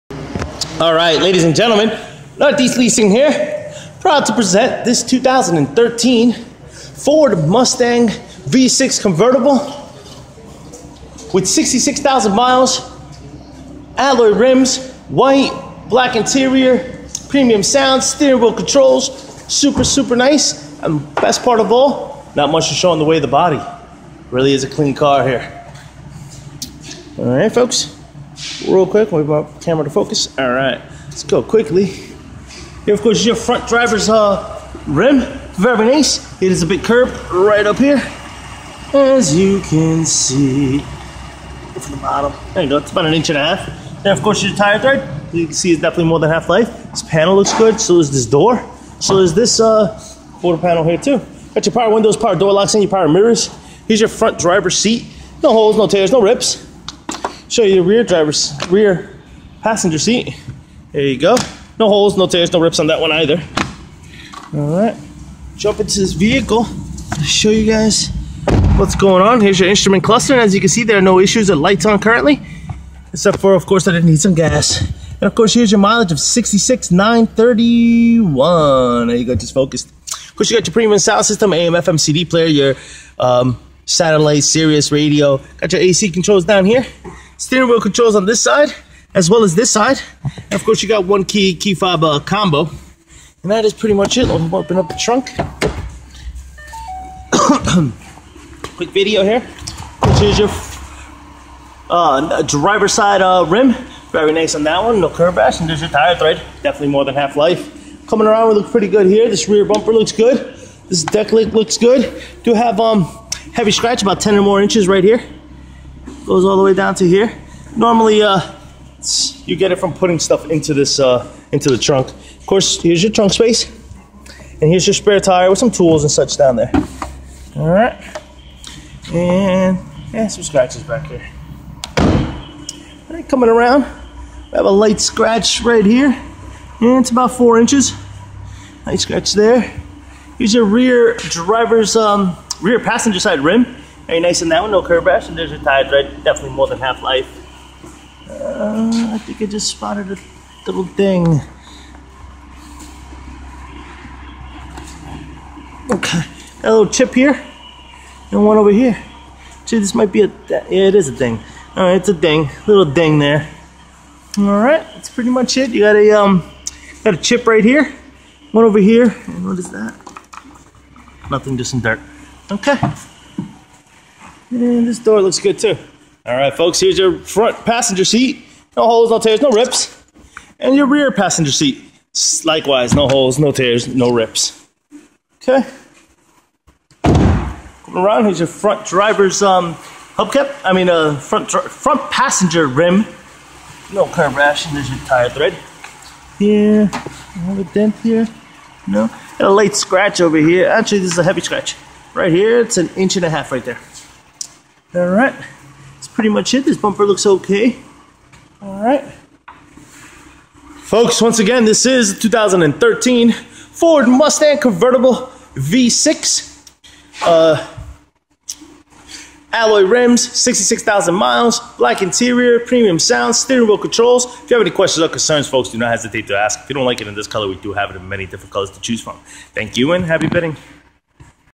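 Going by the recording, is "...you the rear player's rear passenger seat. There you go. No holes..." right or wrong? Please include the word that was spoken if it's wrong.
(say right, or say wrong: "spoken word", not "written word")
wrong: "driver", not "player".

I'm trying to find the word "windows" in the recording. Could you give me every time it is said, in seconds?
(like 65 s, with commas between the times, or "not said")
51 s.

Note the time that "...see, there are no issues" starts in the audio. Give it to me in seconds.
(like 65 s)
70 s.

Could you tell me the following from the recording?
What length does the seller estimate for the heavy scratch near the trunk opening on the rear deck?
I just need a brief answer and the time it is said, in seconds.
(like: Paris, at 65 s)
10 or more inches, at 114 s.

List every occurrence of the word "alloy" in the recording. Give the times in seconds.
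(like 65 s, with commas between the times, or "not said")
13 s, 219 s.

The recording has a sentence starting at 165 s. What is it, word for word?
You got a, um, got a chip right here, one over here, and what is that?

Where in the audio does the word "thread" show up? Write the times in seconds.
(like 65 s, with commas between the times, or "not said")
44 s, 106 s, 195 s.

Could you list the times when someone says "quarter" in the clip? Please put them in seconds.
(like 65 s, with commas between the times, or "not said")
50 s.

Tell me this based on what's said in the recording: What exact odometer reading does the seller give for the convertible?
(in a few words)
66,931.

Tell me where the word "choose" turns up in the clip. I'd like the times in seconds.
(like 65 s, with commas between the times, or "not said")
228 s.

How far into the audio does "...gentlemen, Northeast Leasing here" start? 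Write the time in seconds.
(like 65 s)
1 s.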